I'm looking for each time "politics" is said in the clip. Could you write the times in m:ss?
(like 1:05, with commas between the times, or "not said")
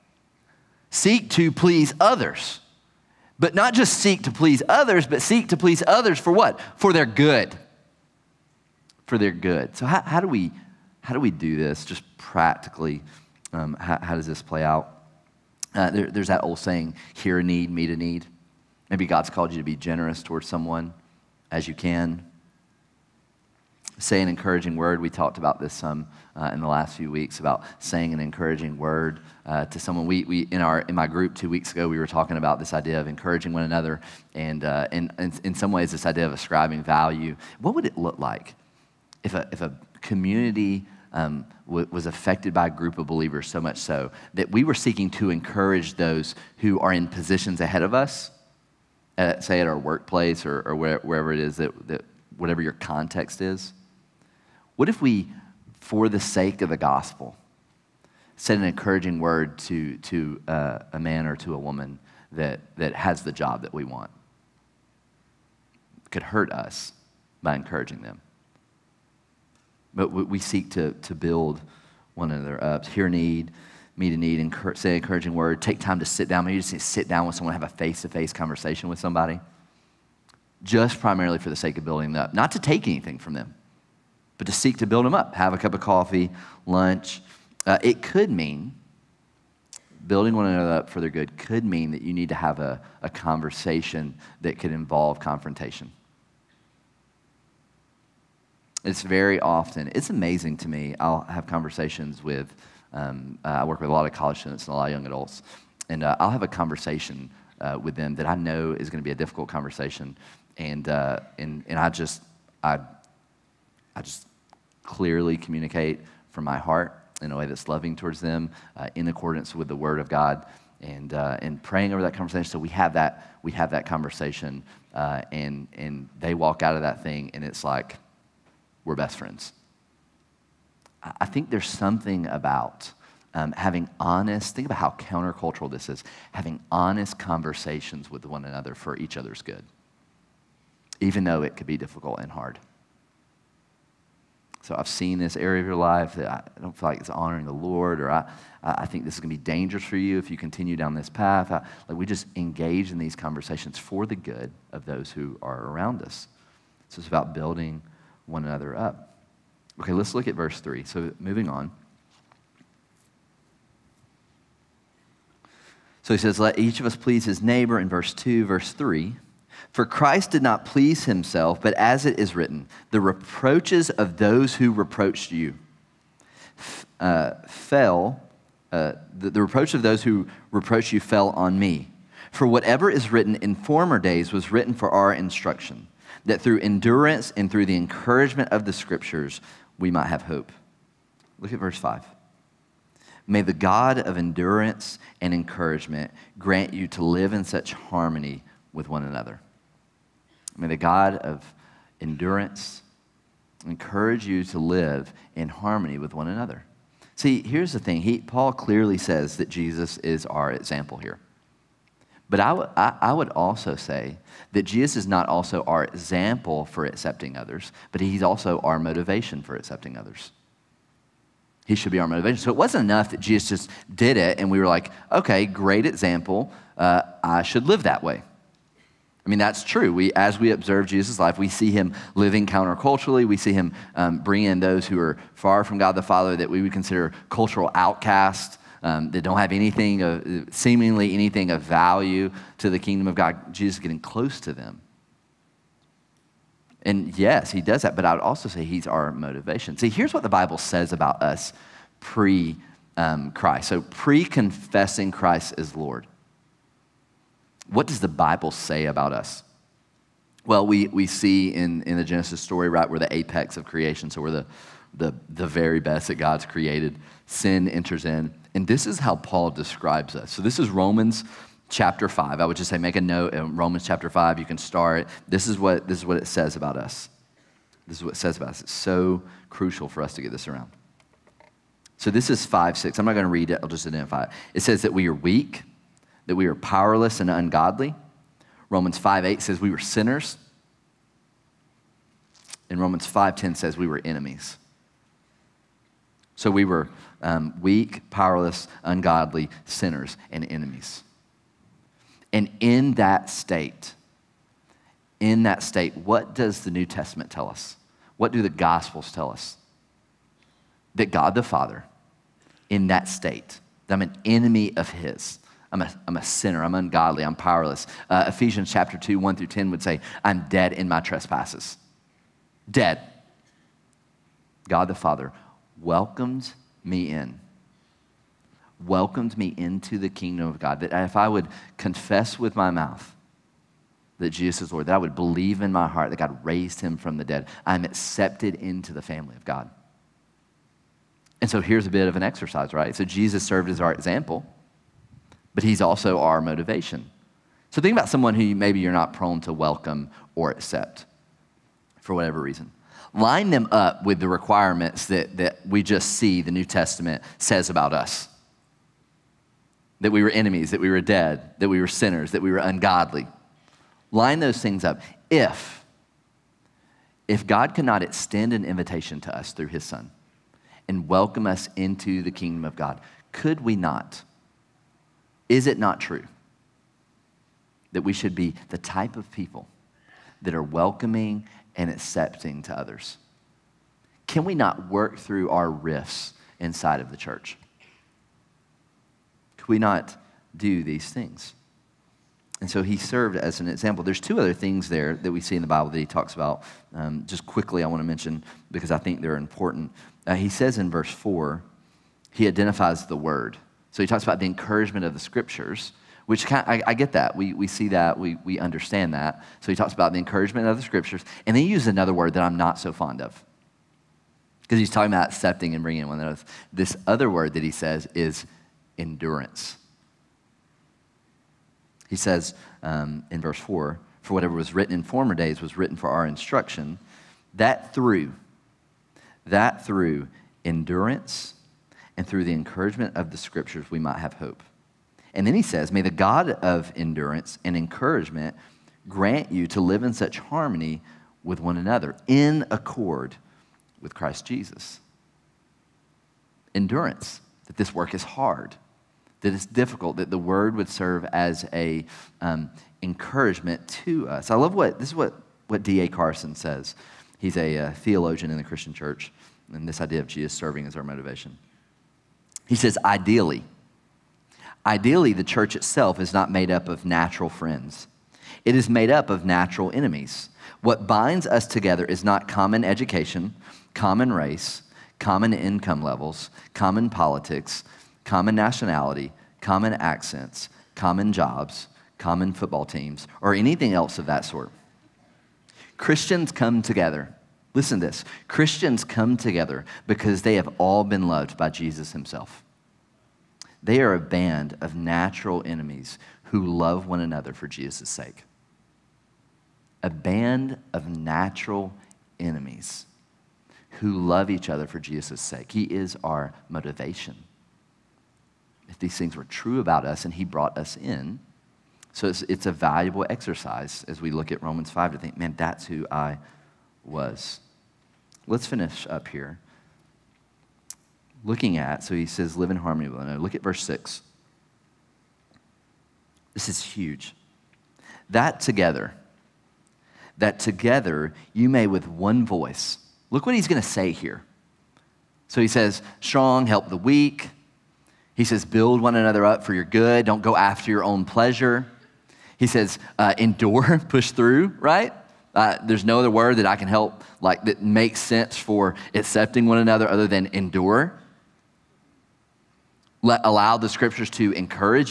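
7:57.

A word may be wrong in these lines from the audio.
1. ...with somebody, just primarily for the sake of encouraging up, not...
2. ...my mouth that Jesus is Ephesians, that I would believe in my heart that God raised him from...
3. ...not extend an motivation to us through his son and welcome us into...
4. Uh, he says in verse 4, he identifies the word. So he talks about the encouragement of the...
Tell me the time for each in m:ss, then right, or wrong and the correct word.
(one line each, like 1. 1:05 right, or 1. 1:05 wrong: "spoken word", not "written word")
1. 1:18 wrong: "building", not "encouraging"
2. 5:32 wrong: "Lord", not "Ephesians"
3. 6:07 wrong: "invitation", not "motivation"
4. 6:40 right.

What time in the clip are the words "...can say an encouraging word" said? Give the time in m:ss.
0:21.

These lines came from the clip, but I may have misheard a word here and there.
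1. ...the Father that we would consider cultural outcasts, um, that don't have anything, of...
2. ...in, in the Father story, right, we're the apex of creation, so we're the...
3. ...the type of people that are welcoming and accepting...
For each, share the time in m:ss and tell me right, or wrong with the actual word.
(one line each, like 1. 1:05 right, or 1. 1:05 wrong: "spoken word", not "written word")
1. 3:55 right
2. 4:21 wrong: "Genesis", not "Father"
3. 6:18 right.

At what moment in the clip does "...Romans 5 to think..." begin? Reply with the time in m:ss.
8:34.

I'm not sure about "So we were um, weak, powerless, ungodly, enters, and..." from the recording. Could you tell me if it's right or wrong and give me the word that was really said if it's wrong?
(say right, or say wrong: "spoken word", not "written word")
wrong: "sinners", not "enters".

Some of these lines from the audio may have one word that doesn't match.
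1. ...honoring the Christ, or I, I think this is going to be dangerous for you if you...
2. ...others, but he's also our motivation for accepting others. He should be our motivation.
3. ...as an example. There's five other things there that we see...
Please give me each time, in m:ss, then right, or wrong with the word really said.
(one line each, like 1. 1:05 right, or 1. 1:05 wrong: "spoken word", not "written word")
1. 2:27 wrong: "Lord", not "Christ"
2. 3:37 right
3. 6:33 wrong: "two", not "five".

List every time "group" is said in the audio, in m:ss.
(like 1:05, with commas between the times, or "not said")
0:31, 0:42.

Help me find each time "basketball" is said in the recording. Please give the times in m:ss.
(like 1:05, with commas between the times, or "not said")
not said.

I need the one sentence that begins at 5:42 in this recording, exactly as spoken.
So Jesus served as our example but he's also our motivation.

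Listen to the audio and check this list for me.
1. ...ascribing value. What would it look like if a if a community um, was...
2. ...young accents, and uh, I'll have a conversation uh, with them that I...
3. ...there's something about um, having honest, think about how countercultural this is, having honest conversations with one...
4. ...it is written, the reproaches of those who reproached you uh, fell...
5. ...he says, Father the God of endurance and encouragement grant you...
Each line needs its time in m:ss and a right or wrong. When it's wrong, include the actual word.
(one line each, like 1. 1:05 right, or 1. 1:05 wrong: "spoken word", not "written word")
1. 0:36 right
2. 1:44 wrong: "adults", not "accents"
3. 2:11 right
4. 2:52 right
5. 7:15 wrong: "May", not "Father".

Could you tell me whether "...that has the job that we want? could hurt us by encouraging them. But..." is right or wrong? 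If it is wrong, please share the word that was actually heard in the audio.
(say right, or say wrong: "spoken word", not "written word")
right.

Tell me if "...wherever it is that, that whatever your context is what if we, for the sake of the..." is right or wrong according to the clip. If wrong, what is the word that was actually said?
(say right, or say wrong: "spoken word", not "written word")
right.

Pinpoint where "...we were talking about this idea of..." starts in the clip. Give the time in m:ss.
0:31.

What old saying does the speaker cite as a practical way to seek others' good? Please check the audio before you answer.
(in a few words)
Hear a need, meet a need.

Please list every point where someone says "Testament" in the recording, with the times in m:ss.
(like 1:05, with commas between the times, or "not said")
5:06, 5:56.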